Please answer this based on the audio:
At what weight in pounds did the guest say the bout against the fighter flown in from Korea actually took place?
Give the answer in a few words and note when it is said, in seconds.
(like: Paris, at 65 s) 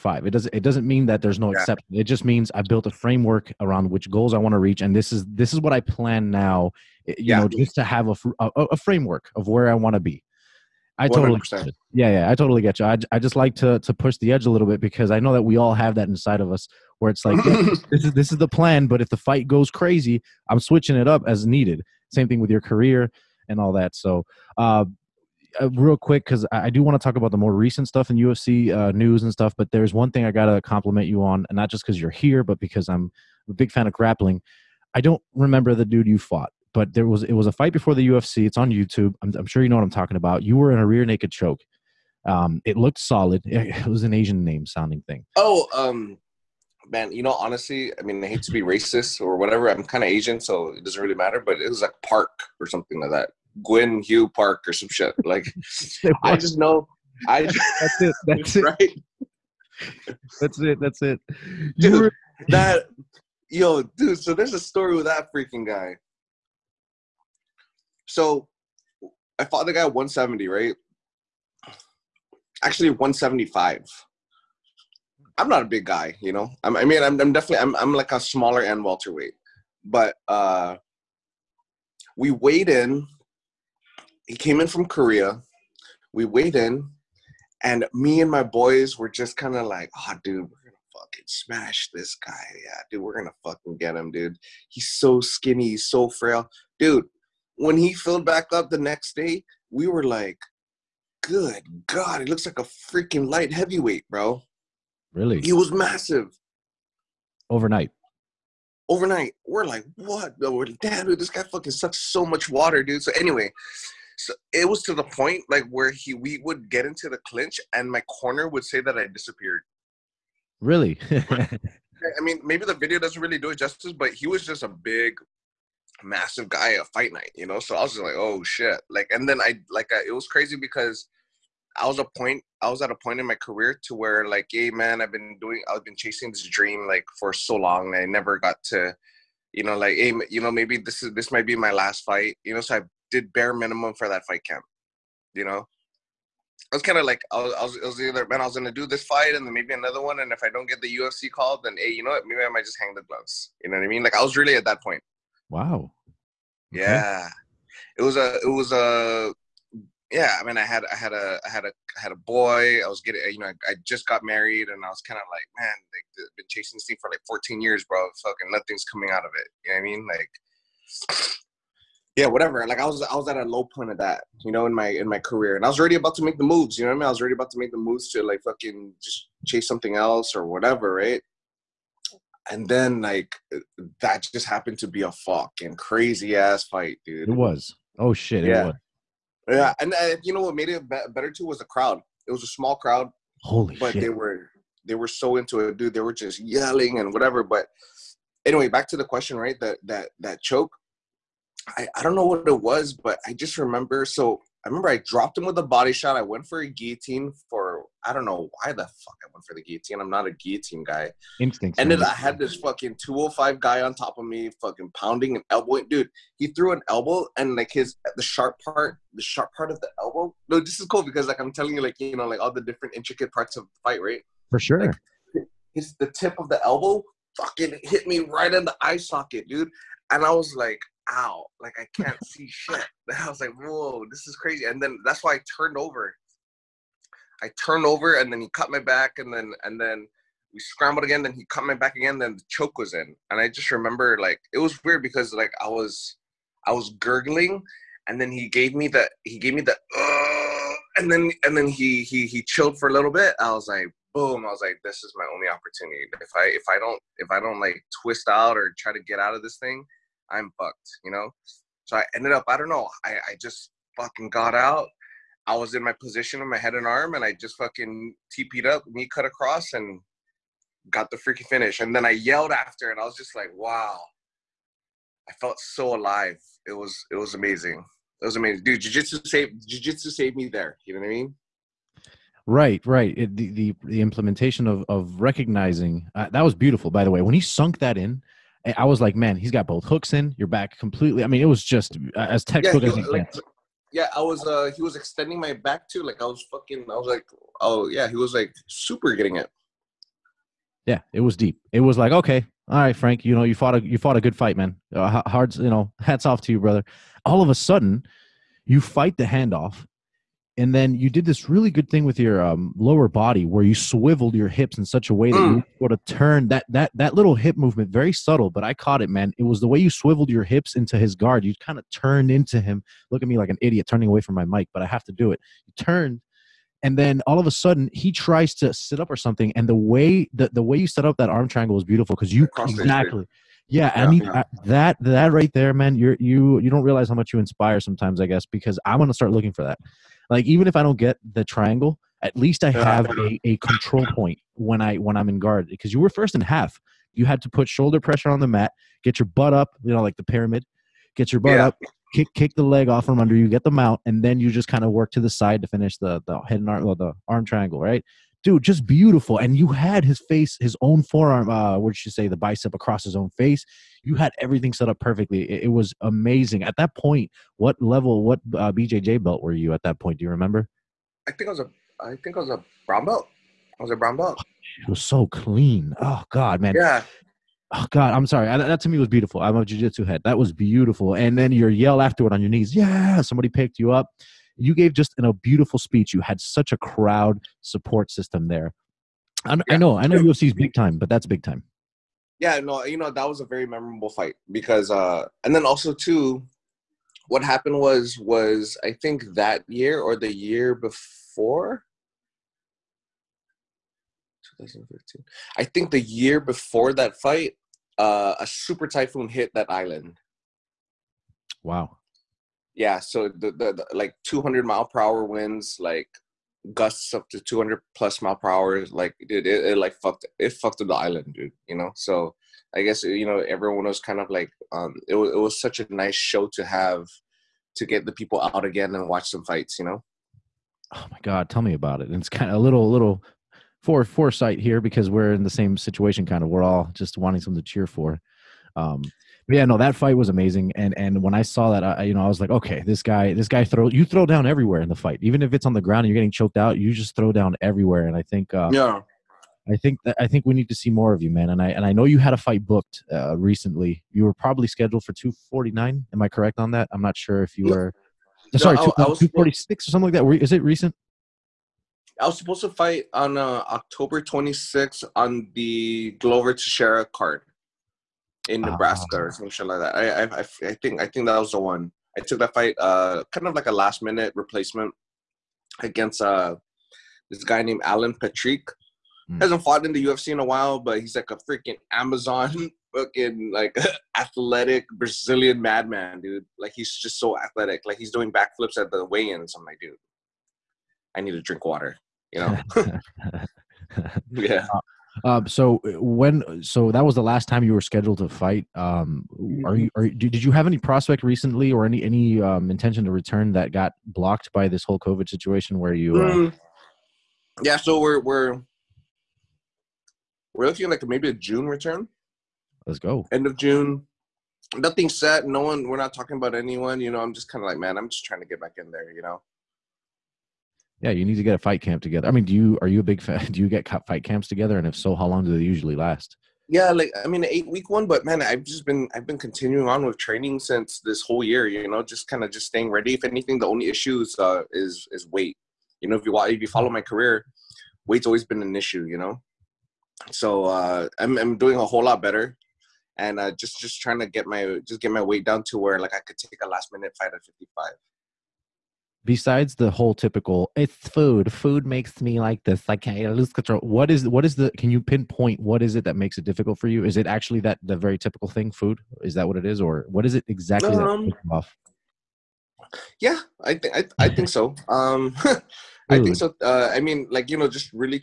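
175, at 72 s.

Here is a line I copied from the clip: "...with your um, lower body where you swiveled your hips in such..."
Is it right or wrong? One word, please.
right.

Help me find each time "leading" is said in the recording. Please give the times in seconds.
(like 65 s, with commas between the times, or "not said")
not said.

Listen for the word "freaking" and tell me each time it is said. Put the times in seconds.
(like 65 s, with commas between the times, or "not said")
65 s, 102 s, 271 s, 481 s.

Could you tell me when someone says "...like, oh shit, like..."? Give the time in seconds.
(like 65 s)
127 s.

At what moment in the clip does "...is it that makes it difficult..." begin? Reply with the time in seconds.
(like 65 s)
555 s.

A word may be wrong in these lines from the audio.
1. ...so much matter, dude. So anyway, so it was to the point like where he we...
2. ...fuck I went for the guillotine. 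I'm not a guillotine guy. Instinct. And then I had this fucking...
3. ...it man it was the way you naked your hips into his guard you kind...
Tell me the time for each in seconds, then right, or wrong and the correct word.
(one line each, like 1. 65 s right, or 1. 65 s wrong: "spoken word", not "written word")
1. 111 s wrong: "water", not "matter"
2. 208 s right
3. 319 s wrong: "swiveled", not "naked".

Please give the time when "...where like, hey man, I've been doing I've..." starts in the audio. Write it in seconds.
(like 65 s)
133 s.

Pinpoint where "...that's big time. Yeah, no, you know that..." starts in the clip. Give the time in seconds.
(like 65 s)
391 s.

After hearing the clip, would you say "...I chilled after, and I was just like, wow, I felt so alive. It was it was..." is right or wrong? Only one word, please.
wrong.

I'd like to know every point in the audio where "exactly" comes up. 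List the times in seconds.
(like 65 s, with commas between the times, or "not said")
332 s, 560 s.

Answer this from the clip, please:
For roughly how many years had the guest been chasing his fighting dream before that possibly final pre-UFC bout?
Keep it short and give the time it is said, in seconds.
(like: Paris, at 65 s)
14, at 167 s.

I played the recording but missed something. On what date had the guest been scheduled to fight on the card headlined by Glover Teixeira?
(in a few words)
October 26th.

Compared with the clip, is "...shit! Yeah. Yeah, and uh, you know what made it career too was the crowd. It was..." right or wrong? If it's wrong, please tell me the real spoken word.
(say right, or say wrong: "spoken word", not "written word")
wrong: "better", not "career".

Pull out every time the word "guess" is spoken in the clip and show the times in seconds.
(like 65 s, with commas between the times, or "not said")
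338 s, 422 s.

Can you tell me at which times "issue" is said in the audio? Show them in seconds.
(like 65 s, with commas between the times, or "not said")
533 s, 538 s.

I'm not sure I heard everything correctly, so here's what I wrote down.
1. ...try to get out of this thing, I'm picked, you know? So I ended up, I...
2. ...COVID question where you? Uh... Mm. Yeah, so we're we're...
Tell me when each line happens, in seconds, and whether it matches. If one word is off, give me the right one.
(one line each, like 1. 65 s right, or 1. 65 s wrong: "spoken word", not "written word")
1. 258 s wrong: "fucked", not "picked"
2. 504 s wrong: "situation", not "question".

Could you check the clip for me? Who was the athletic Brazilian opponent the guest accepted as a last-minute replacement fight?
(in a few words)
Alan Patrick.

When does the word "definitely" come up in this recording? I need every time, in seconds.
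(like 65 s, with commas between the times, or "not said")
77 s.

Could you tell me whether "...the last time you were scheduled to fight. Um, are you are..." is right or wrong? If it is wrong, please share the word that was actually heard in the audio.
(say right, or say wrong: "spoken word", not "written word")
right.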